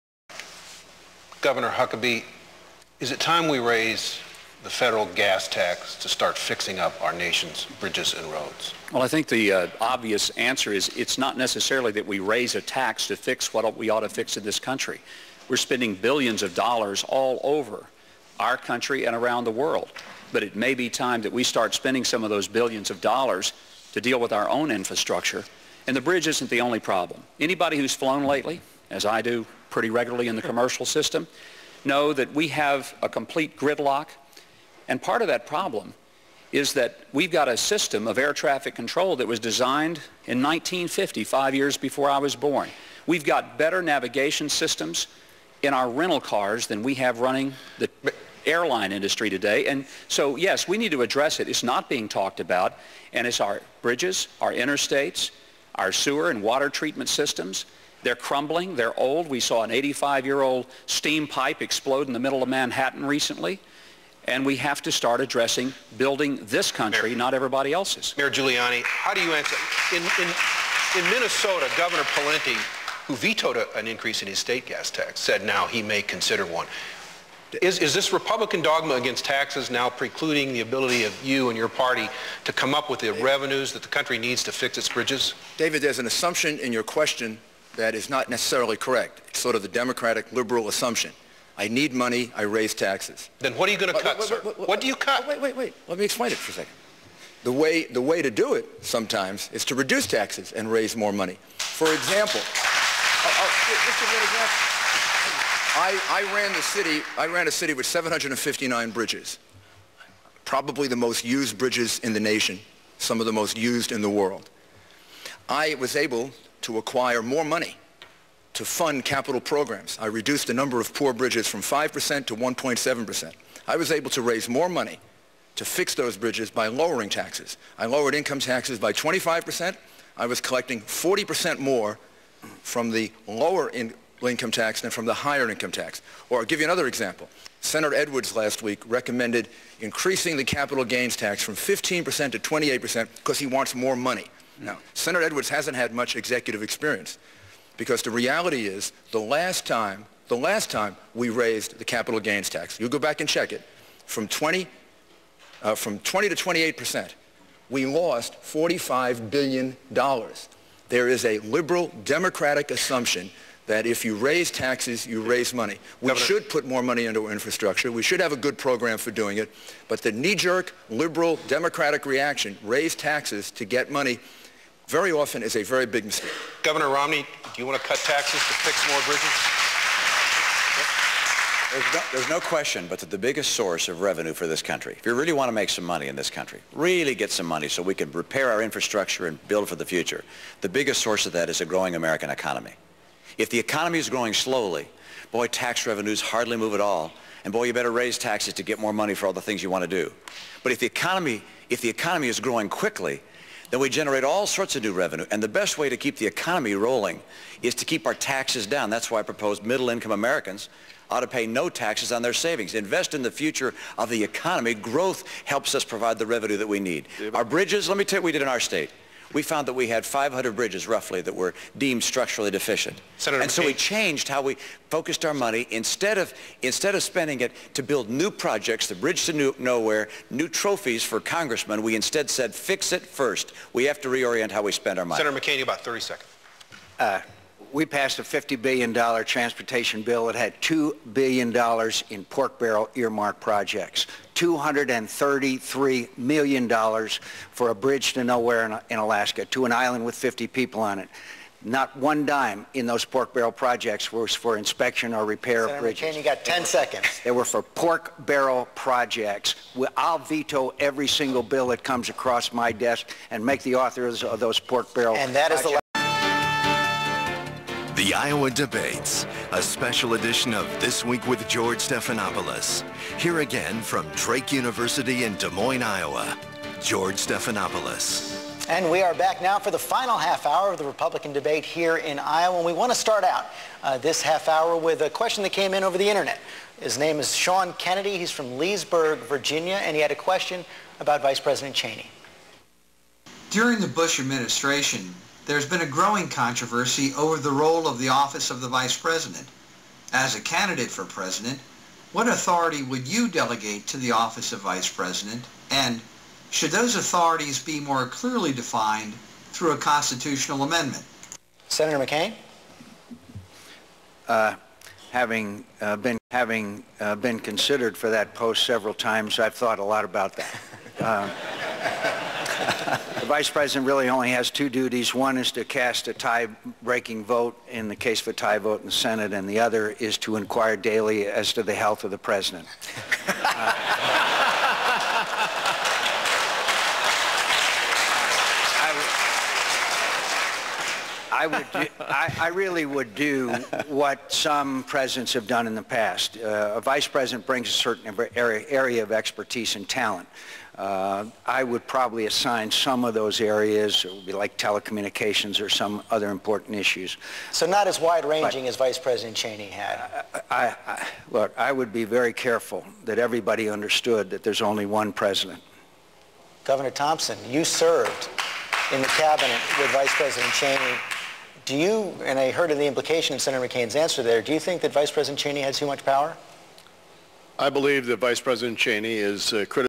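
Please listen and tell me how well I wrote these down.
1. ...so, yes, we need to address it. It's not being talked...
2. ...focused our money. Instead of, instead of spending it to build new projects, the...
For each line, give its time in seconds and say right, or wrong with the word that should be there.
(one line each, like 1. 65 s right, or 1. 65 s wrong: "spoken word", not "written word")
1. 50 s right
2. 224 s right.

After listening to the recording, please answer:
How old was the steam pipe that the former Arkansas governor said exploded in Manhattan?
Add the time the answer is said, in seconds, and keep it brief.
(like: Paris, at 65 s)
85 years, at 59 s.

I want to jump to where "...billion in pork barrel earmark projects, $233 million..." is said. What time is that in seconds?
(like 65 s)
241 s.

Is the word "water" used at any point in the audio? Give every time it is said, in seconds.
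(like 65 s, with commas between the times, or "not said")
56 s.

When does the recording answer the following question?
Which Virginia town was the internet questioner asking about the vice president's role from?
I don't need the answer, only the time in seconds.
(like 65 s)
288 s.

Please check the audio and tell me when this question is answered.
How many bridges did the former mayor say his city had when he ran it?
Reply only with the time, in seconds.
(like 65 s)
107 s.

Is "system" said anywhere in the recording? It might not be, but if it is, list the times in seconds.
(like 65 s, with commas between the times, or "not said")
30 s, 37 s, 44 s, 57 s.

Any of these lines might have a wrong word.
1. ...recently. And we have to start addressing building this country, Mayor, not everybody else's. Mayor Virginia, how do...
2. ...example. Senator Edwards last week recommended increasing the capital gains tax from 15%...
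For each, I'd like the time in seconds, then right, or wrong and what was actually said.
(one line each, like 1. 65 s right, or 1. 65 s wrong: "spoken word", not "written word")
1. 63 s wrong: "Giuliani", not "Virginia"
2. 136 s right.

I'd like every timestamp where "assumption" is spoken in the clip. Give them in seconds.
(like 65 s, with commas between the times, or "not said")
86 s, 90 s, 162 s.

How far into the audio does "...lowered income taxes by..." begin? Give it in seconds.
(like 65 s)
127 s.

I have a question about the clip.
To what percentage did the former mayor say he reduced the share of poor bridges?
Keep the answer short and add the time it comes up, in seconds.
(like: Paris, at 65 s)
1.7%, at 122 s.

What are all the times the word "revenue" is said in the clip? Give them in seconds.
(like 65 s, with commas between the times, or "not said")
83 s, 184 s, 195 s, 204 s, 216 s.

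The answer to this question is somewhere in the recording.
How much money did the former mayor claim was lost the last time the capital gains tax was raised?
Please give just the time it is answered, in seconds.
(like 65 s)
158 s.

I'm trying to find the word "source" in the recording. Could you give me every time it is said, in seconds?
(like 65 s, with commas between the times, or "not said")
183 s, 191 s.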